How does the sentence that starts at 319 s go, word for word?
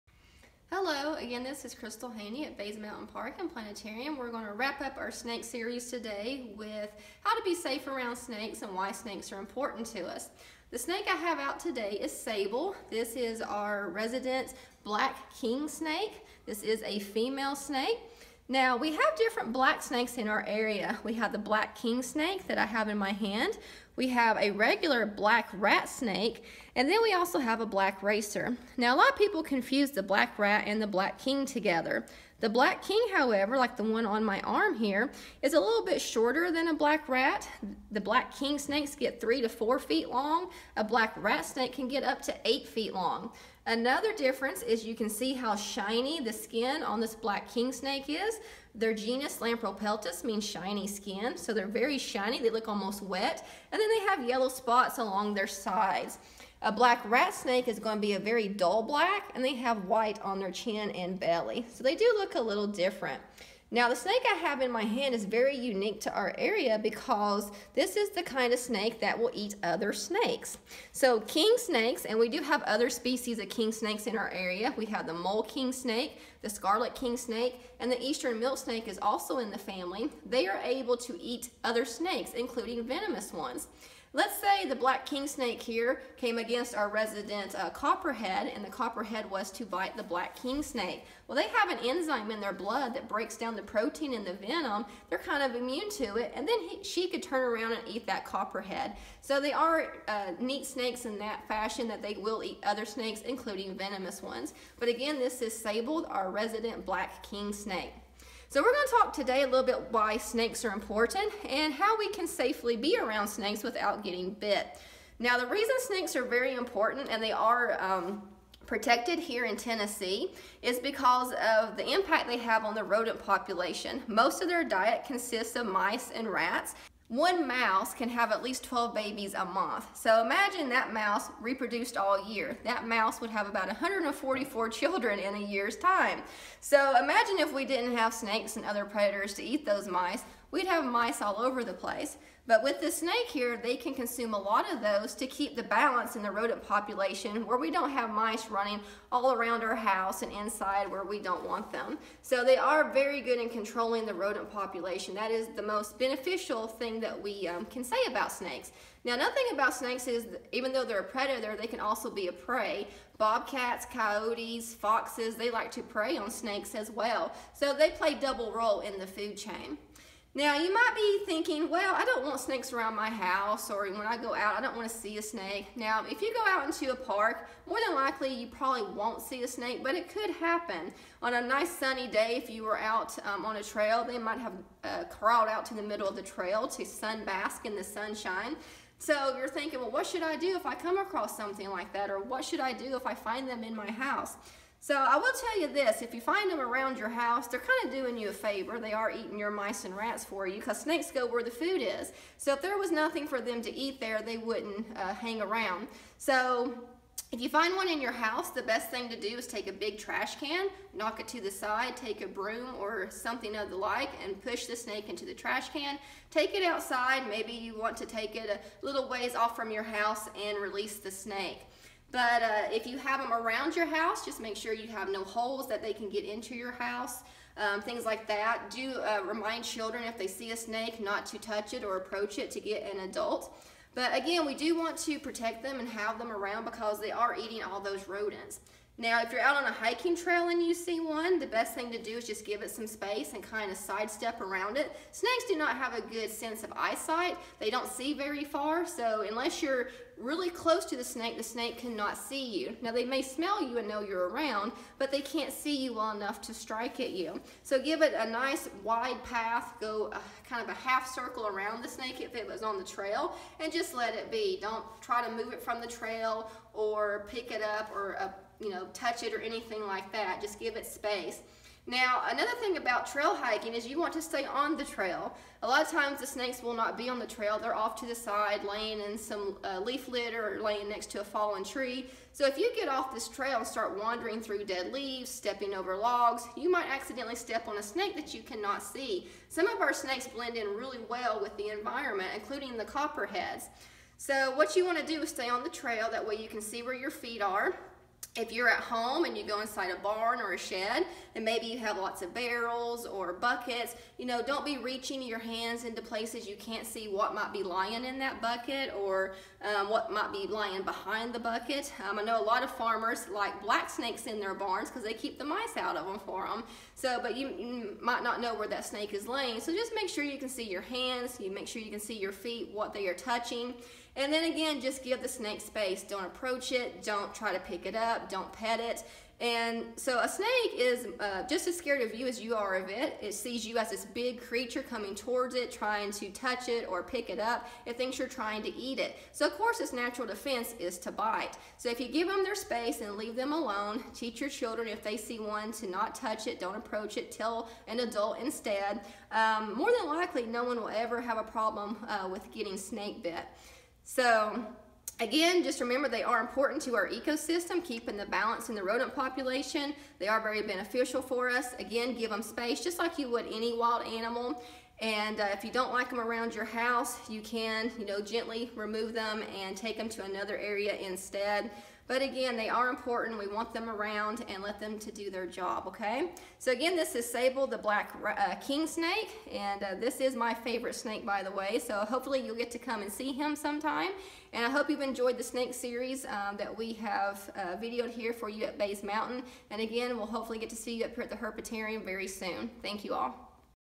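So just make sure you can see your hands, you make sure you can see your feet, what they are touching.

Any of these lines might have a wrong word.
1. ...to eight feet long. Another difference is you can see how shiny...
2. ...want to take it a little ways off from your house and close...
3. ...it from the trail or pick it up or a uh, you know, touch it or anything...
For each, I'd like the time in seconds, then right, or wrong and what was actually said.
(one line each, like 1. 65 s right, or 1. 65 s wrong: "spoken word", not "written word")
1. 42 s right
2. 217 s wrong: "release", not "close"
3. 265 s right.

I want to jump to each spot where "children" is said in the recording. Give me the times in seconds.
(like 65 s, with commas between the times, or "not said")
134 s, 229 s, 344 s.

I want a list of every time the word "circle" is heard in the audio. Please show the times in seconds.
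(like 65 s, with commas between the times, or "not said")
261 s.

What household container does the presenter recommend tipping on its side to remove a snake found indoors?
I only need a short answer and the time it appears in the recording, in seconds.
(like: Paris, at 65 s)
a big trash can, at 209 s.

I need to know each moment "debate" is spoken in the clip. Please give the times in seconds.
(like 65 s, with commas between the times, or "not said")
not said.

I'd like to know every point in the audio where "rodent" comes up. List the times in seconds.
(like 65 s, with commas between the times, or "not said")
122 s, 146 s, 154 s, 238 s, 358 s.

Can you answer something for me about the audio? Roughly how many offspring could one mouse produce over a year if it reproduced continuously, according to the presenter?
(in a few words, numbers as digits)
144.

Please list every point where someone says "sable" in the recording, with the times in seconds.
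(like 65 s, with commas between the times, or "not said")
12 s, 105 s, 377 s.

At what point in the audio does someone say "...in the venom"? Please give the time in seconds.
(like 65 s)
94 s.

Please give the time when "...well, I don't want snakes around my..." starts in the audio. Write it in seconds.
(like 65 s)
171 s.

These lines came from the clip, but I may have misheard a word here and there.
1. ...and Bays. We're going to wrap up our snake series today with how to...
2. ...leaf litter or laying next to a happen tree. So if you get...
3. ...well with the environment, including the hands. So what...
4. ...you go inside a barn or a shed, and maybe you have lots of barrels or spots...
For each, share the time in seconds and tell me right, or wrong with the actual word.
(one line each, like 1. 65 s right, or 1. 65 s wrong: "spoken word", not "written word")
1. 3 s wrong: "Planetarium", not "Bays"
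2. 279 s wrong: "fallen", not "happen"
3. 291 s wrong: "copperheads", not "hands"
4. 299 s wrong: "buckets", not "spots".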